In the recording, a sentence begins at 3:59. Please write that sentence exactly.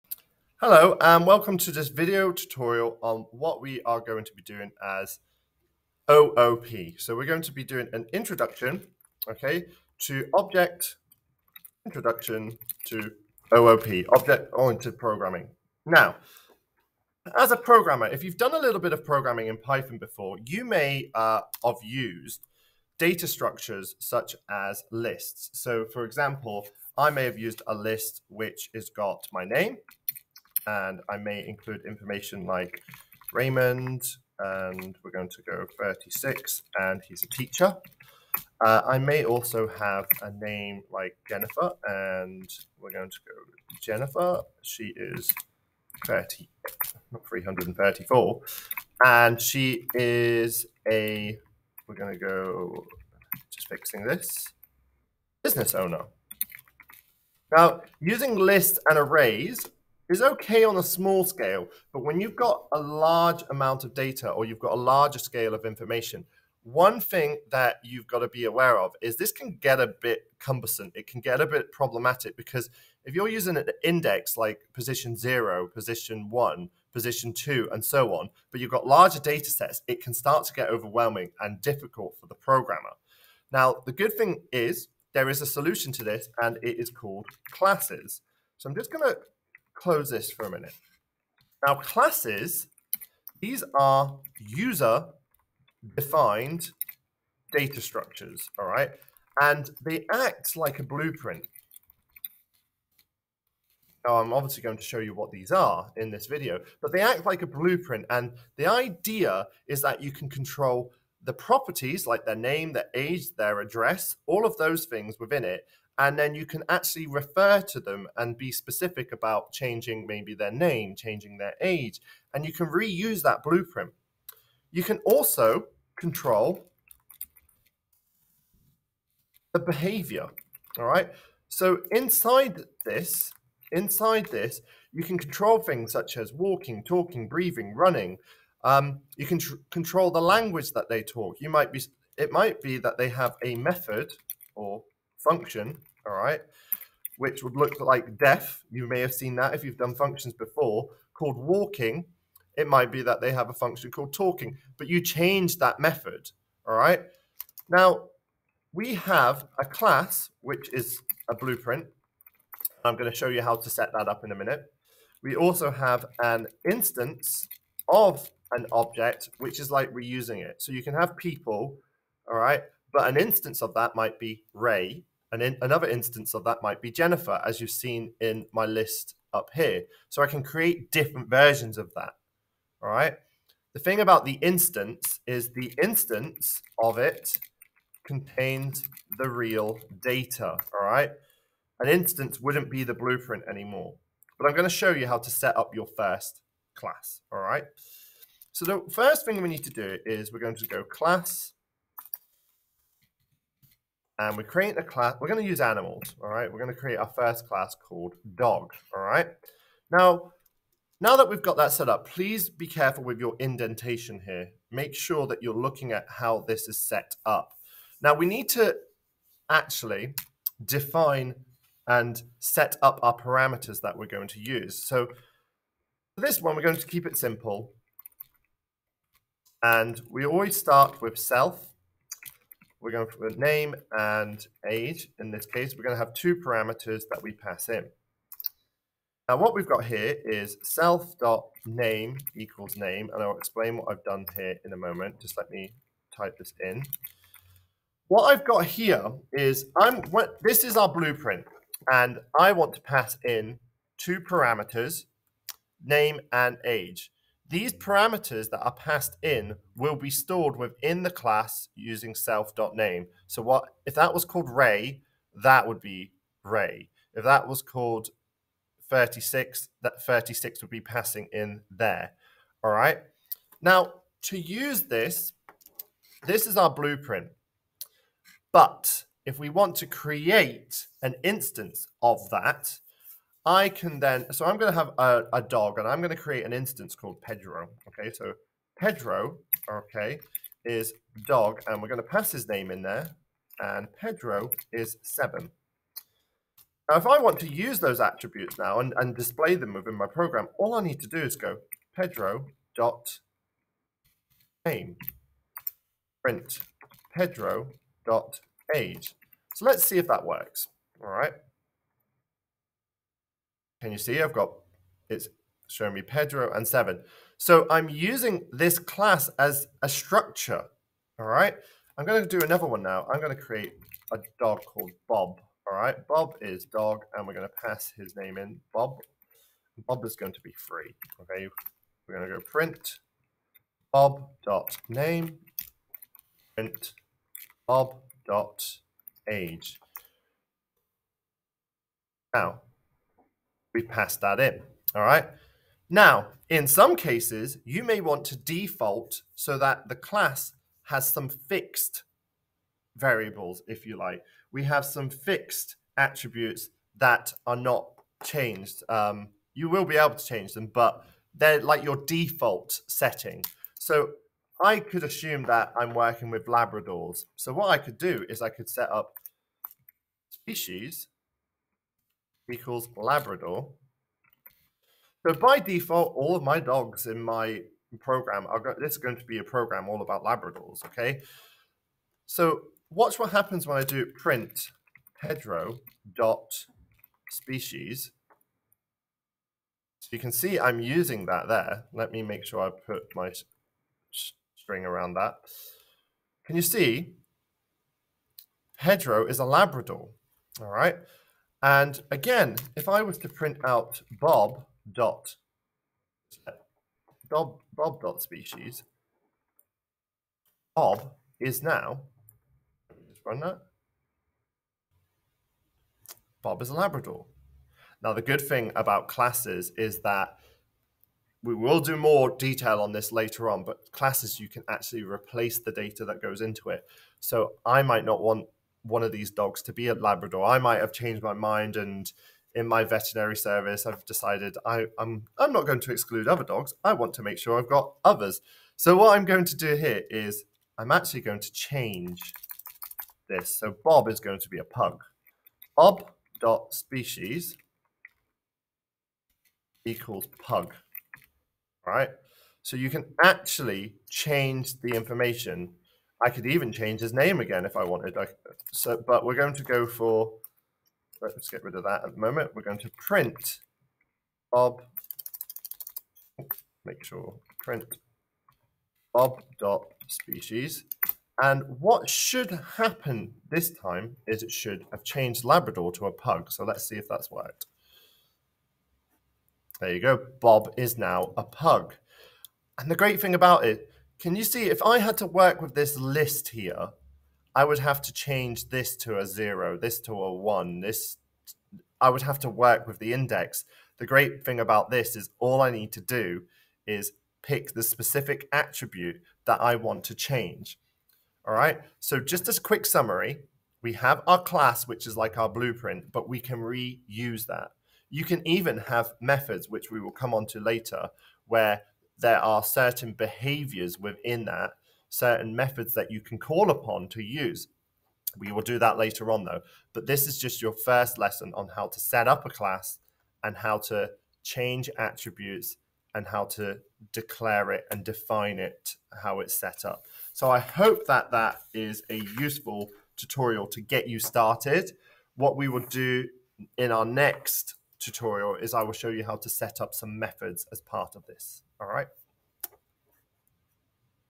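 Now, what we've got here is self.name equals name, and I'll explain what I've done here in a moment.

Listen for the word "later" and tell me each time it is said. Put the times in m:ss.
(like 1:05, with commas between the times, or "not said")
7:03, 8:30, 8:38.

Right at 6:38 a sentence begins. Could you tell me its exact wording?
Pedro is a Labrador, all right?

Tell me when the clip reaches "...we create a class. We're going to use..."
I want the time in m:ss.
3:24.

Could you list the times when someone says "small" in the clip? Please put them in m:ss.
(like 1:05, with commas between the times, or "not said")
1:00.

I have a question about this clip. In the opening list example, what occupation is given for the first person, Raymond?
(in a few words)
Teacher.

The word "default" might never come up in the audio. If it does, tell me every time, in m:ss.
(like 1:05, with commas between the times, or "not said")
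5:48, 6:02, 6:15.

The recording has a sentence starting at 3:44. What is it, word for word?
So for this one, we're going to keep it simple.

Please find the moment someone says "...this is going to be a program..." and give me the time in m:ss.
6:18.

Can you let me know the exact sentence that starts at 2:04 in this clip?
You can also control the behavior, all right?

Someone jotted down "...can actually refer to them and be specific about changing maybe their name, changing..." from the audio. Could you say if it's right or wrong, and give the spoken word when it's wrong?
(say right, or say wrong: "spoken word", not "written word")
right.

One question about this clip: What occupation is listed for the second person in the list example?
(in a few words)
Business owner.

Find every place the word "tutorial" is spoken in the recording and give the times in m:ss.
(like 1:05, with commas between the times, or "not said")
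0:02, 8:53, 8:57.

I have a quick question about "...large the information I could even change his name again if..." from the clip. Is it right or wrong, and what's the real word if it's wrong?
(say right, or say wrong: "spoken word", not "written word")
wrong: "change", not "large".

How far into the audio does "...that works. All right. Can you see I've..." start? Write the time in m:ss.
5:10.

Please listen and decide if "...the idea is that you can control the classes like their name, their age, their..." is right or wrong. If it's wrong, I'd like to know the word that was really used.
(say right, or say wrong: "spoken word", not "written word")
wrong: "properties", not "classes".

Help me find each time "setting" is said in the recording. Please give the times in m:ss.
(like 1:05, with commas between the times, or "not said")
6:02.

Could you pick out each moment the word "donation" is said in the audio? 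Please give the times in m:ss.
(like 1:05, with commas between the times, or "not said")
not said.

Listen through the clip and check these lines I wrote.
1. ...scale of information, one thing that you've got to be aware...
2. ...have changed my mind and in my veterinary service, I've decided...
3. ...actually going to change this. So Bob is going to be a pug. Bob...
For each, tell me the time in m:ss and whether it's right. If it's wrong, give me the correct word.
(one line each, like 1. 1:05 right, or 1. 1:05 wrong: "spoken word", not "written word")
1. 1:05 right
2. 7:10 right
3. 7:20 right.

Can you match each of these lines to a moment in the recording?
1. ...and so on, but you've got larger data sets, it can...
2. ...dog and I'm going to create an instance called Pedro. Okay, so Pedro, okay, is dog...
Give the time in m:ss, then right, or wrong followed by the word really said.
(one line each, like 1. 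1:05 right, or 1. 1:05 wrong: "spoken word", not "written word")
1. 1:17 right
2. 4:45 right.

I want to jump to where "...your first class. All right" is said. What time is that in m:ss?
3:15.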